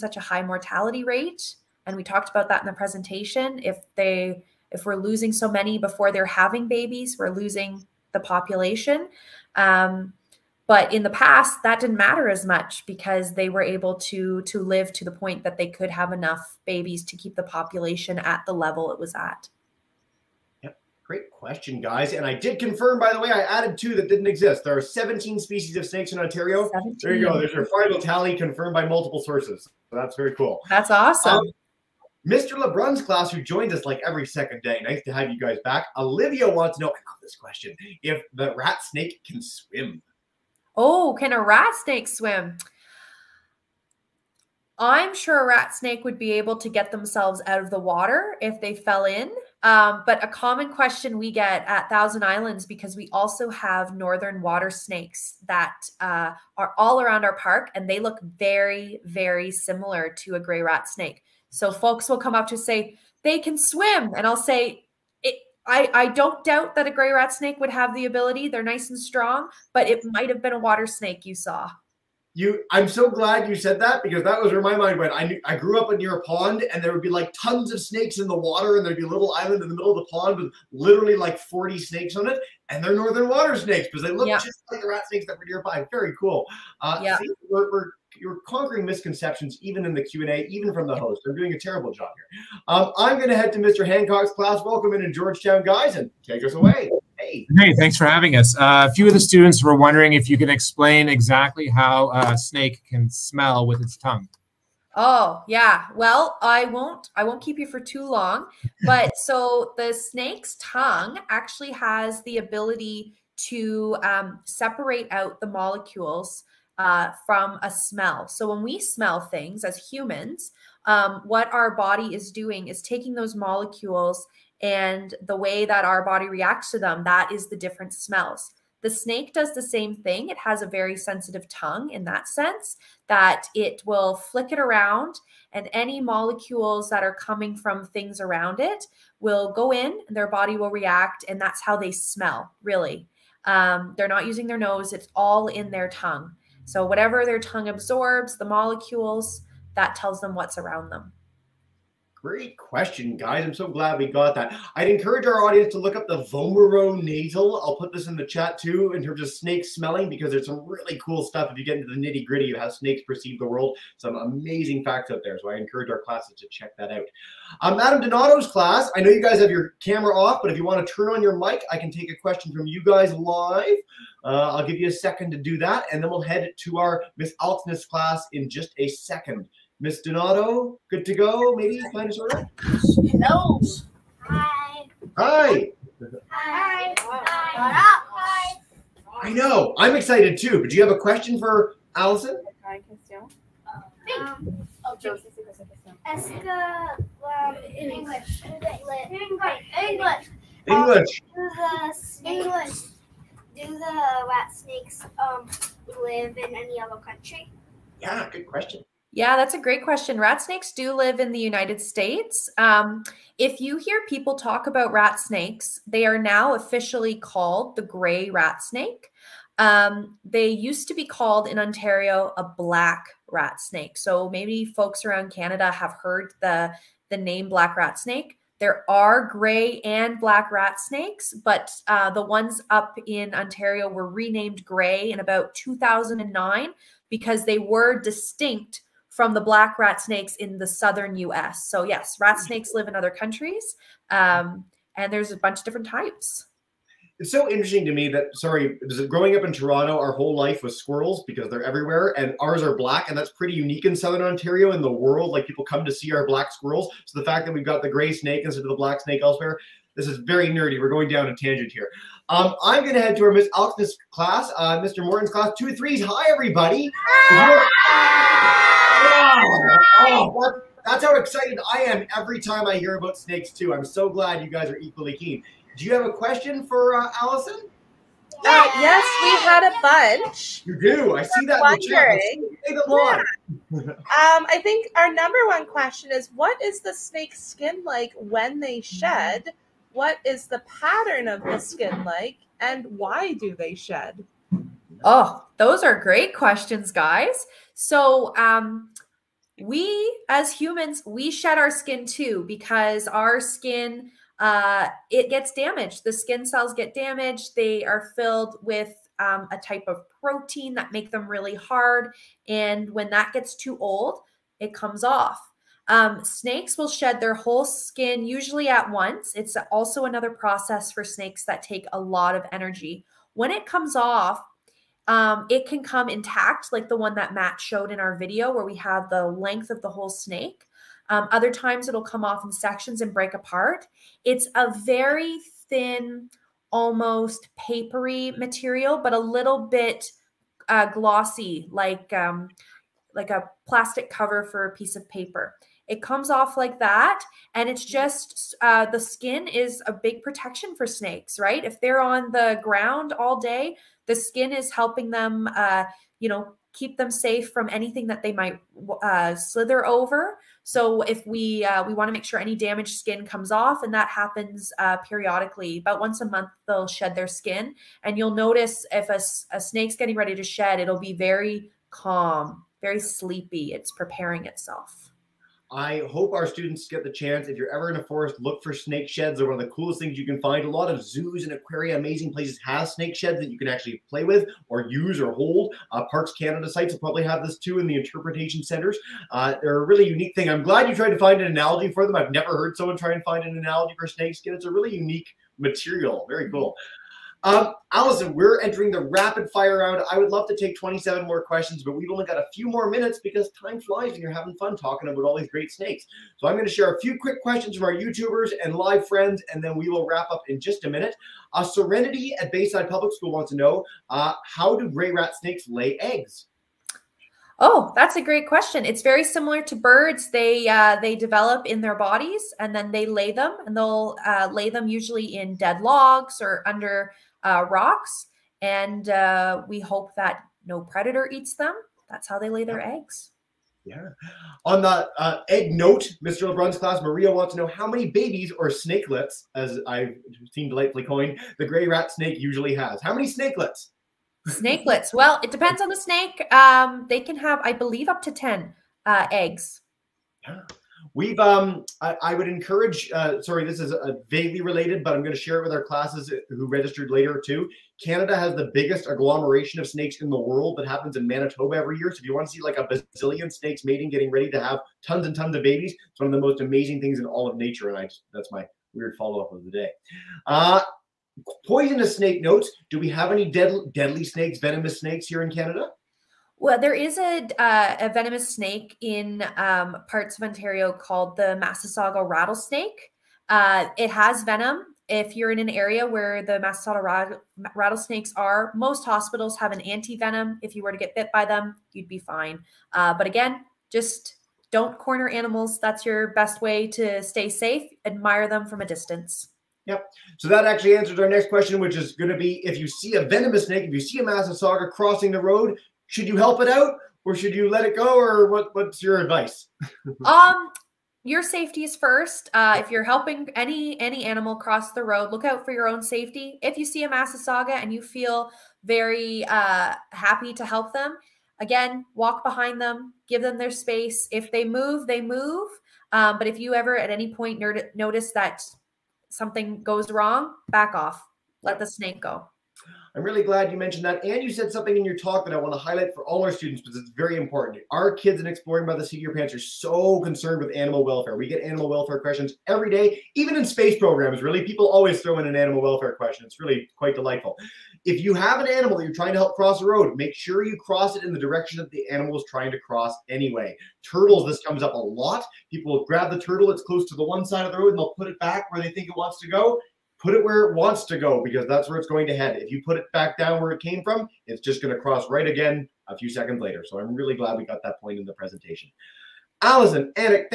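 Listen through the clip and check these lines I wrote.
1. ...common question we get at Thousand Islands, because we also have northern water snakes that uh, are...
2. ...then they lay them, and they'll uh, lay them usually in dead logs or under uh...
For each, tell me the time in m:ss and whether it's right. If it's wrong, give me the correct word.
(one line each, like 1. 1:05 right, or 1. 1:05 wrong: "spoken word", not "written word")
1. 0:50 right
2. 7:02 right.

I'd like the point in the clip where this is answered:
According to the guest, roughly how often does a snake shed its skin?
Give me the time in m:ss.
6:05.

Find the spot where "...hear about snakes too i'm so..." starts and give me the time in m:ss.
4:32.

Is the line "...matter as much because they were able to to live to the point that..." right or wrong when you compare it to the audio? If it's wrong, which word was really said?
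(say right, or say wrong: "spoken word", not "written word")
right.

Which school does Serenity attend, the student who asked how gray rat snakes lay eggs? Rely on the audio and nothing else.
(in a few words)
Bayside Public School.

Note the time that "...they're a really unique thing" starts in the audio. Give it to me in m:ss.
6:29.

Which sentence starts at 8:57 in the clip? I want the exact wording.
Our kids in Exploring by the Seat of Your Pants are so concerned with animal welfare.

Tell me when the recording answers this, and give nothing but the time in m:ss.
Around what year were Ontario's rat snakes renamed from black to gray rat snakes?
3:55.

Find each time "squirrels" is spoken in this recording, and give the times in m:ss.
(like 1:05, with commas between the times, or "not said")
4:10, 4:16.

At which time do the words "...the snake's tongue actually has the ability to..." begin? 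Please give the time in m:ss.
1:49.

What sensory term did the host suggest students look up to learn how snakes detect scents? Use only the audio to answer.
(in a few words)
Vomeronasal.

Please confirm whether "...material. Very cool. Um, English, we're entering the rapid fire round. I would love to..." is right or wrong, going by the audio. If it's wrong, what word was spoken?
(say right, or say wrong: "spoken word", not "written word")
wrong: "Allison", not "English".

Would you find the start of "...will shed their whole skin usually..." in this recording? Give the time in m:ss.
5:16.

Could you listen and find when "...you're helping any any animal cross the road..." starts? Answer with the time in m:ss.
8:32.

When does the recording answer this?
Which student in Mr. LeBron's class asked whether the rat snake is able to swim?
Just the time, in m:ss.
0:35.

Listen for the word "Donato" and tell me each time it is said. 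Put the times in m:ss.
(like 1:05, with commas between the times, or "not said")
2:48, 3:00.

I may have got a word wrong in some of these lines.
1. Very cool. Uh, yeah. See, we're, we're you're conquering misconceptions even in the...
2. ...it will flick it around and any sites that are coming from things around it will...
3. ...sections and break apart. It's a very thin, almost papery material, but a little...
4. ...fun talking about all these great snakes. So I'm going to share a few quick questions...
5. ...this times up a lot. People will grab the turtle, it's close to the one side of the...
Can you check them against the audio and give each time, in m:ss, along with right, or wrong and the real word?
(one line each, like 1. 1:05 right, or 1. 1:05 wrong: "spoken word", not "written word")
1. 1:25 right
2. 2:13 wrong: "molecules", not "sites"
3. 5:32 right
4. 6:44 right
5. 9:14 wrong: "comes", not "times".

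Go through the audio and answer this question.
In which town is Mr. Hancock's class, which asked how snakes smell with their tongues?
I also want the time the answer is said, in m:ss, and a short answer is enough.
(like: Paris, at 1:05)
Georgetown, at 1:35.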